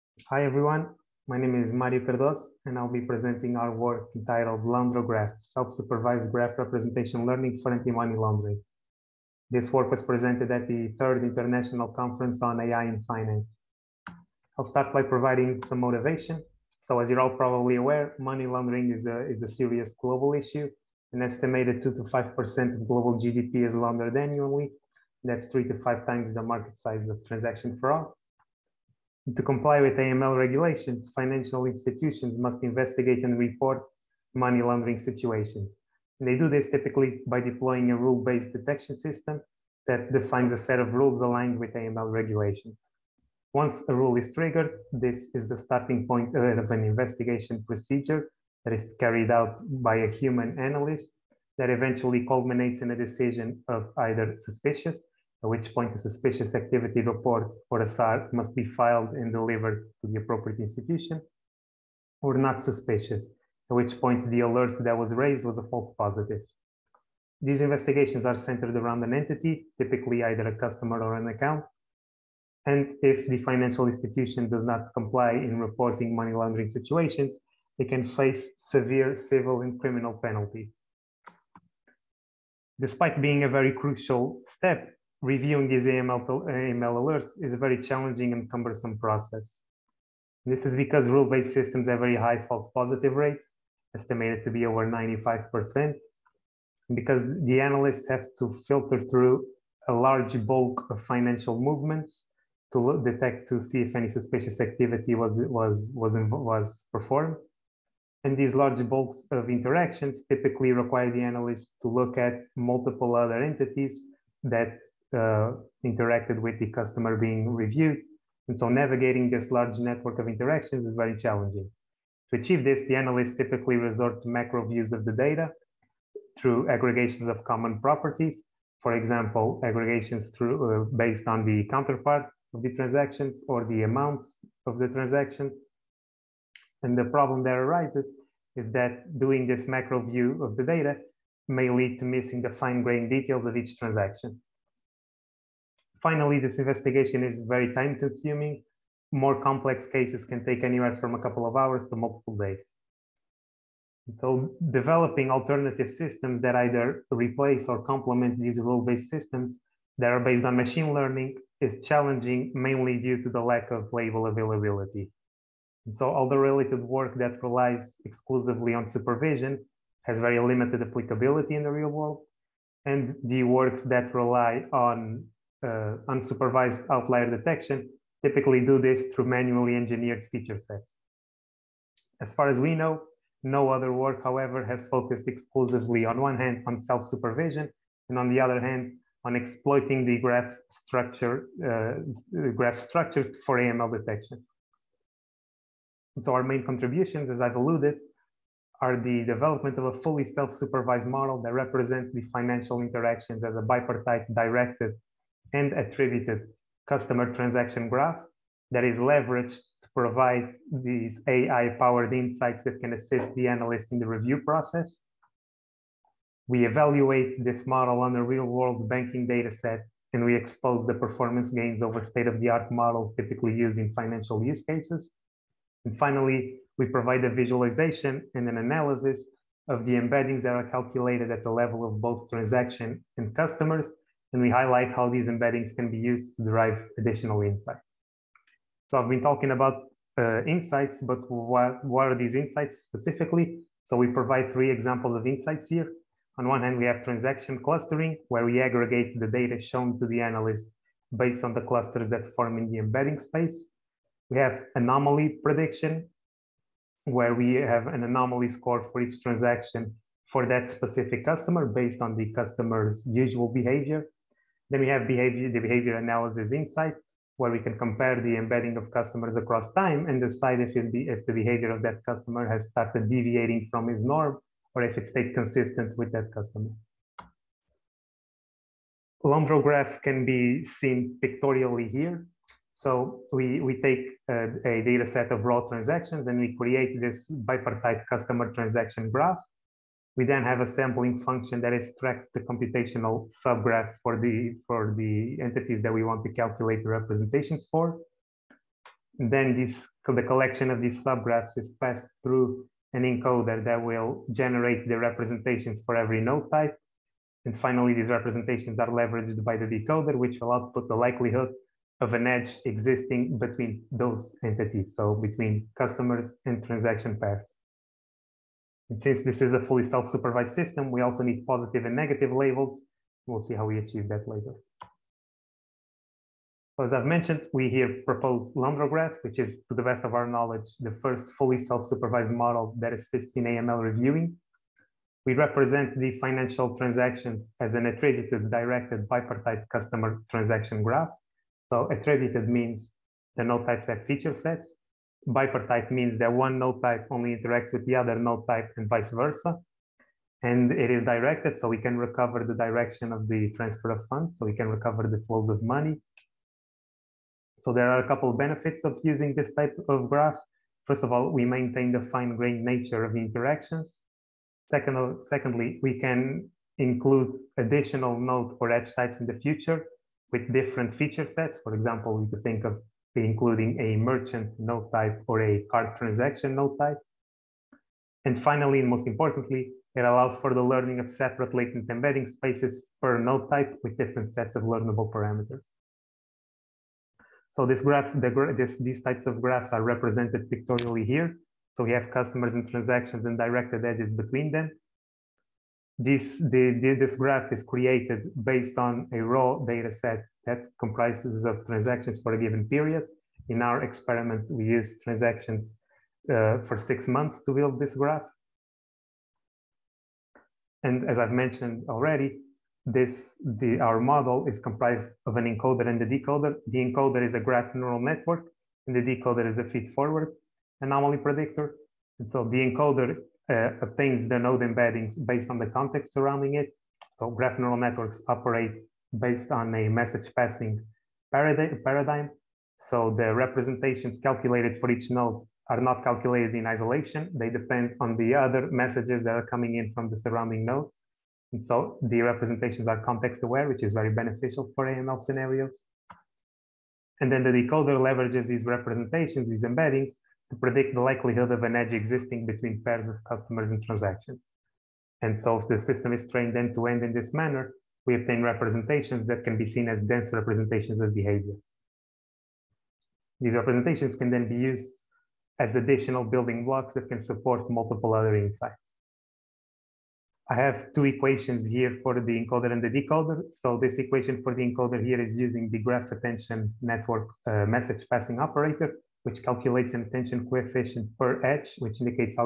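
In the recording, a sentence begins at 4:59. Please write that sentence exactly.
And then this, the collection of these subgraphs is passed through an encoder that will generate the representations for every node type.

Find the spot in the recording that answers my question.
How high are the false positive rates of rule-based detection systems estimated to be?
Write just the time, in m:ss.
1:34.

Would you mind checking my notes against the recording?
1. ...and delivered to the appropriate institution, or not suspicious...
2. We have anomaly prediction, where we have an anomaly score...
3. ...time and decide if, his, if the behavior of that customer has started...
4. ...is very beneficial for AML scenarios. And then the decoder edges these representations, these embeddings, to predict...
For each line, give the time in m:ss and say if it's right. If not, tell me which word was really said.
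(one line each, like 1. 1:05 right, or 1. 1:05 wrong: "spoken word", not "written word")
1. 0:59 right
2. 4:14 right
3. 4:29 right
4. 7:23 wrong: "leverages", not "edges".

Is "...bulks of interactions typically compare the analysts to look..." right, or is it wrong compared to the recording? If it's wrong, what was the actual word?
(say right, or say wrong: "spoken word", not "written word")
wrong: "require", not "compare".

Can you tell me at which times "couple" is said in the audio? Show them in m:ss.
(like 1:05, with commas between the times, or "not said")
2:31, 5:58.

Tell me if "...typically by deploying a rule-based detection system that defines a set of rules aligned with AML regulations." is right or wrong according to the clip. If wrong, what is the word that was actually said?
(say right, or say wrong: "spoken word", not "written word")
right.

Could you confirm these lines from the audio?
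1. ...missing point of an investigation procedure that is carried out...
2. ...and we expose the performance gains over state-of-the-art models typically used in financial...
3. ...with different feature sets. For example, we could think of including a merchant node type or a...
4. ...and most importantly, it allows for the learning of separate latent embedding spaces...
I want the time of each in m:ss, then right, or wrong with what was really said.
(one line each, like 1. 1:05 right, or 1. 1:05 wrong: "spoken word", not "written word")
1. 0:45 wrong: "starting", not "missing"
2. 3:40 right
3. 6:10 right
4. 6:18 right.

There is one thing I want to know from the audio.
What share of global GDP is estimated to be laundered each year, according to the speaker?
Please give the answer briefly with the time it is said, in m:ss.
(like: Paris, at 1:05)
2 to 5%, at 0:21.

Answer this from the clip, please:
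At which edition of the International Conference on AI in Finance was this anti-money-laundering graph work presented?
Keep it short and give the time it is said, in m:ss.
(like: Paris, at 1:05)
third, at 0:10.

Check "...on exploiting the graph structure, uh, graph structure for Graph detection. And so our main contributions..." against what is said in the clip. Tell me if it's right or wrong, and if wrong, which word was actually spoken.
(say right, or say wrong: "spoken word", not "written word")
wrong: "AML", not "Graph".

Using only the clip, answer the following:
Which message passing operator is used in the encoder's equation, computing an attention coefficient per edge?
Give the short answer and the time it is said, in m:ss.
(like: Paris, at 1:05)
graph attention network, at 7:55.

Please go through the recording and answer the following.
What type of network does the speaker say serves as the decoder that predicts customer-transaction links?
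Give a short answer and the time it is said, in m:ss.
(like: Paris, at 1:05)
feed-forward anomaly predictor, at 6:59.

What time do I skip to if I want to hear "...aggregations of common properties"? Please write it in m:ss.
2:06.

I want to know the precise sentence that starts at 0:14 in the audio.
I'll start by providing some motivation.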